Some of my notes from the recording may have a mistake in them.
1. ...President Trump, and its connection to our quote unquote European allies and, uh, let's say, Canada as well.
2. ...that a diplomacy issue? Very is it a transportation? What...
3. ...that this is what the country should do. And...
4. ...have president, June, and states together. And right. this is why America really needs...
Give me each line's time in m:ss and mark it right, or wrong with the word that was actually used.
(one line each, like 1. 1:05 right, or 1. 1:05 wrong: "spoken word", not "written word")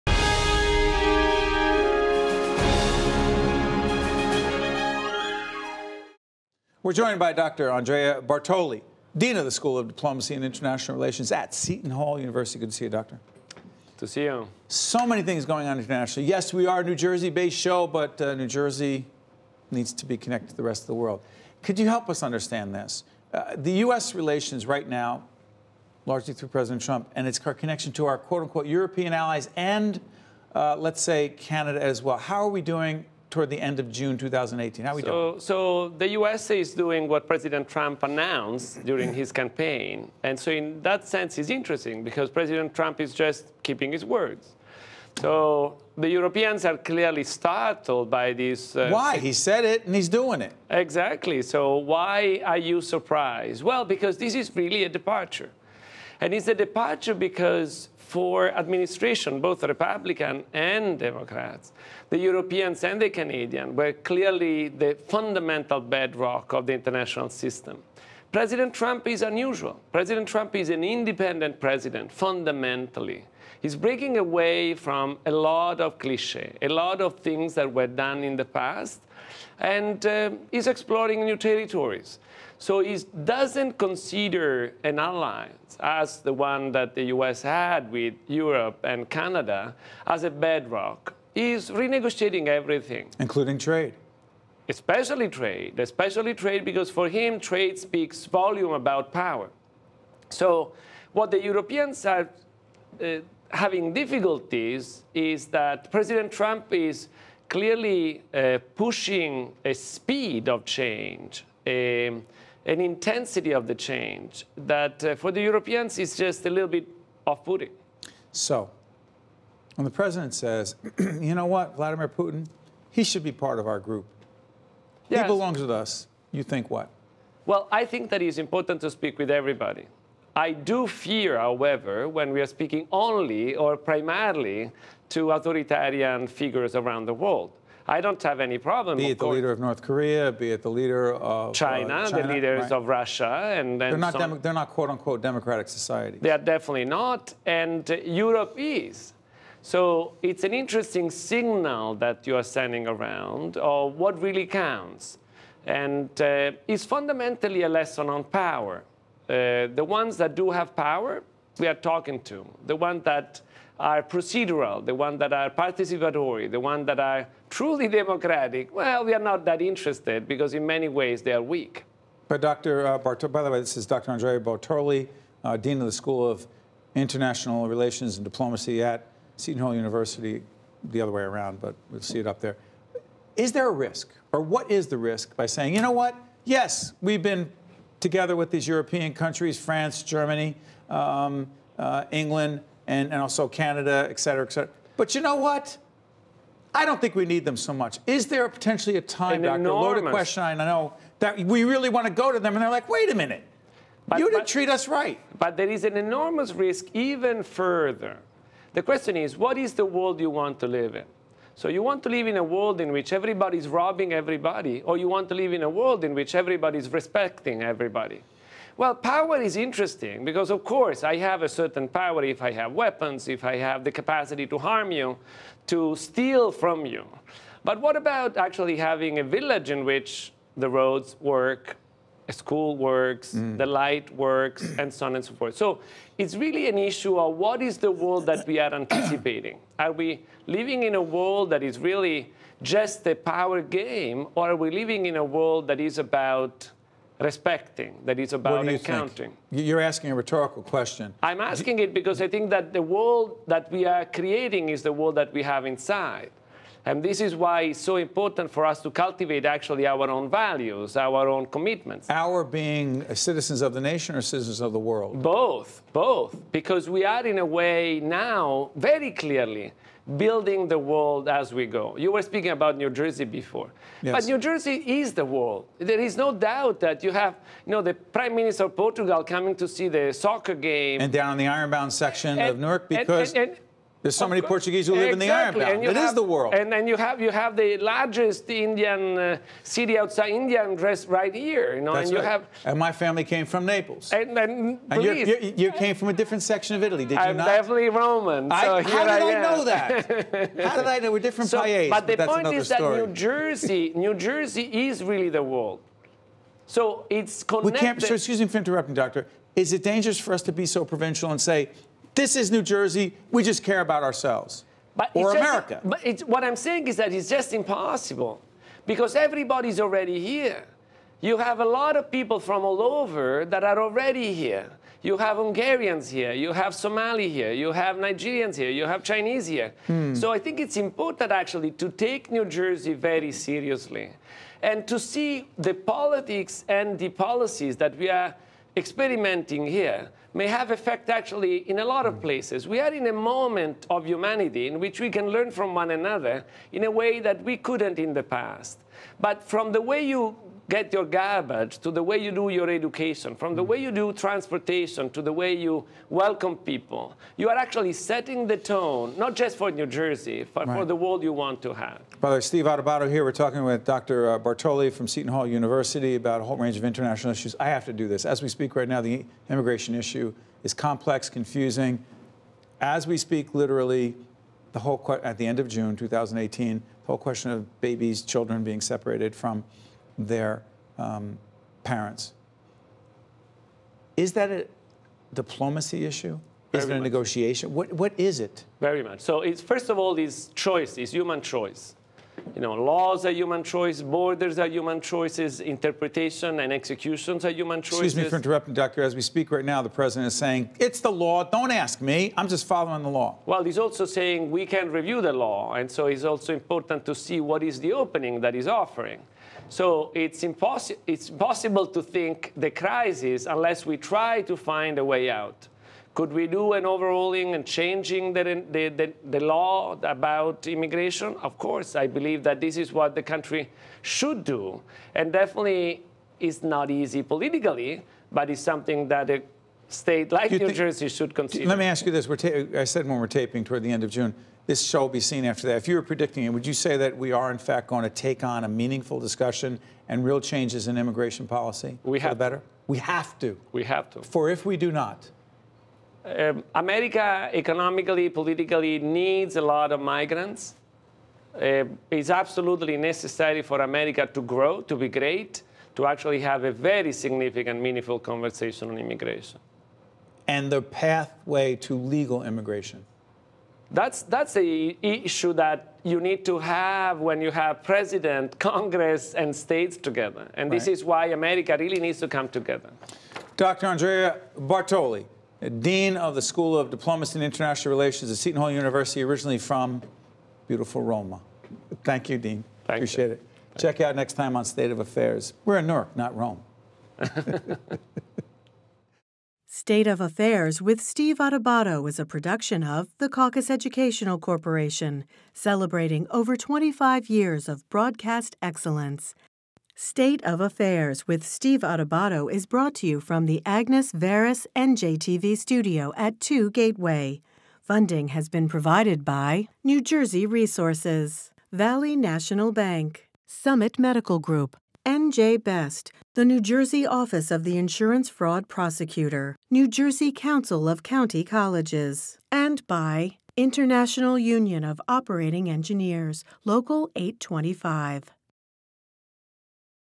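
1. 0:26 right
2. 6:24 wrong: "negotiation", not "transportation"
3. 7:02 right
4. 7:47 wrong: "Congress", not "June".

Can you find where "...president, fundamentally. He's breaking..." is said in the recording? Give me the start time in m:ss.
1:11.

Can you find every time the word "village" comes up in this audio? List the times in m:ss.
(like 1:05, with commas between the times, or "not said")
3:49.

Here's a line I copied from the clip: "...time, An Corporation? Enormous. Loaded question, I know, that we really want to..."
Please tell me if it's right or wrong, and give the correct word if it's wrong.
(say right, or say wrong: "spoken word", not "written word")
wrong: "Doctor", not "Corporation".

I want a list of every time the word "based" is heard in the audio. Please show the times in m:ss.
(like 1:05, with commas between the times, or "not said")
0:17.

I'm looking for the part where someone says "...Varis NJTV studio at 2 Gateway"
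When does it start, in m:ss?
8:24.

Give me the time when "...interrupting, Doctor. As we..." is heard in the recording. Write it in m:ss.
6:38.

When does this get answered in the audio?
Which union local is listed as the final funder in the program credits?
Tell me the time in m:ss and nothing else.
8:46.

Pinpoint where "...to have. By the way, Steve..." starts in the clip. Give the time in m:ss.
6:01.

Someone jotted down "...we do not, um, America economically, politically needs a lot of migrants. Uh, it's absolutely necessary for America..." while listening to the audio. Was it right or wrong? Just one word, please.
right.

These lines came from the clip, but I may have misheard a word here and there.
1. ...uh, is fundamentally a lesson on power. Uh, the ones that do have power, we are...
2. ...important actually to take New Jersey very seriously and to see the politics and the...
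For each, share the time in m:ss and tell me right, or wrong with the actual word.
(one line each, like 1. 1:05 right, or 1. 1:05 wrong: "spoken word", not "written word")
1. 2:36 right
2. 5:30 right.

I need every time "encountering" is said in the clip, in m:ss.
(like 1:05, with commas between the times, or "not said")
4:08.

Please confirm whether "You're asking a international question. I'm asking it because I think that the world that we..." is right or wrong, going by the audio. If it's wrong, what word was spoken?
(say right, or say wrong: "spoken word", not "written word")
wrong: "rhetorical", not "international".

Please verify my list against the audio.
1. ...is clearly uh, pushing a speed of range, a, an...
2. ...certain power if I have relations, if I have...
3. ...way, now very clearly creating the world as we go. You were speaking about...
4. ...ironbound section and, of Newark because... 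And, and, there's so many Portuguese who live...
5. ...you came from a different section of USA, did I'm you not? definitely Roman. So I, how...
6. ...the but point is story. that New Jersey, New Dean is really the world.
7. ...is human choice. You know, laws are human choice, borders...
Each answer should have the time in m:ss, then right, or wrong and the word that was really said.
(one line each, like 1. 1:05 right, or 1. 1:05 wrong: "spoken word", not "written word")
1. 1:46 wrong: "change", not "range"
2. 3:41 wrong: "weapons", not "relations"
3. 4:27 wrong: "building", not "creating"
4. 4:41 right
5. 4:55 wrong: "Italy", not "USA"
6. 5:02 wrong: "Jersey", not "Dean"
7. 6:30 right.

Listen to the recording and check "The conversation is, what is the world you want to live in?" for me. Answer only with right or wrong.
wrong.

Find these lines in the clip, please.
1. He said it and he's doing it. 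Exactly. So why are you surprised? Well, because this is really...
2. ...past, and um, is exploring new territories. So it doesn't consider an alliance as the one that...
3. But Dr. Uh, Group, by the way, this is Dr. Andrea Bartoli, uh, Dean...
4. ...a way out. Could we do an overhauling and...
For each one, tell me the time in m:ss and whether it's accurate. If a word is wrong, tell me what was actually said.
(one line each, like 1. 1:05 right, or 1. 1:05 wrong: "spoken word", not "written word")
1. 0:49 right
2. 1:18 right
3. 2:52 wrong: "Bartoli", not "Group"
4. 6:54 right.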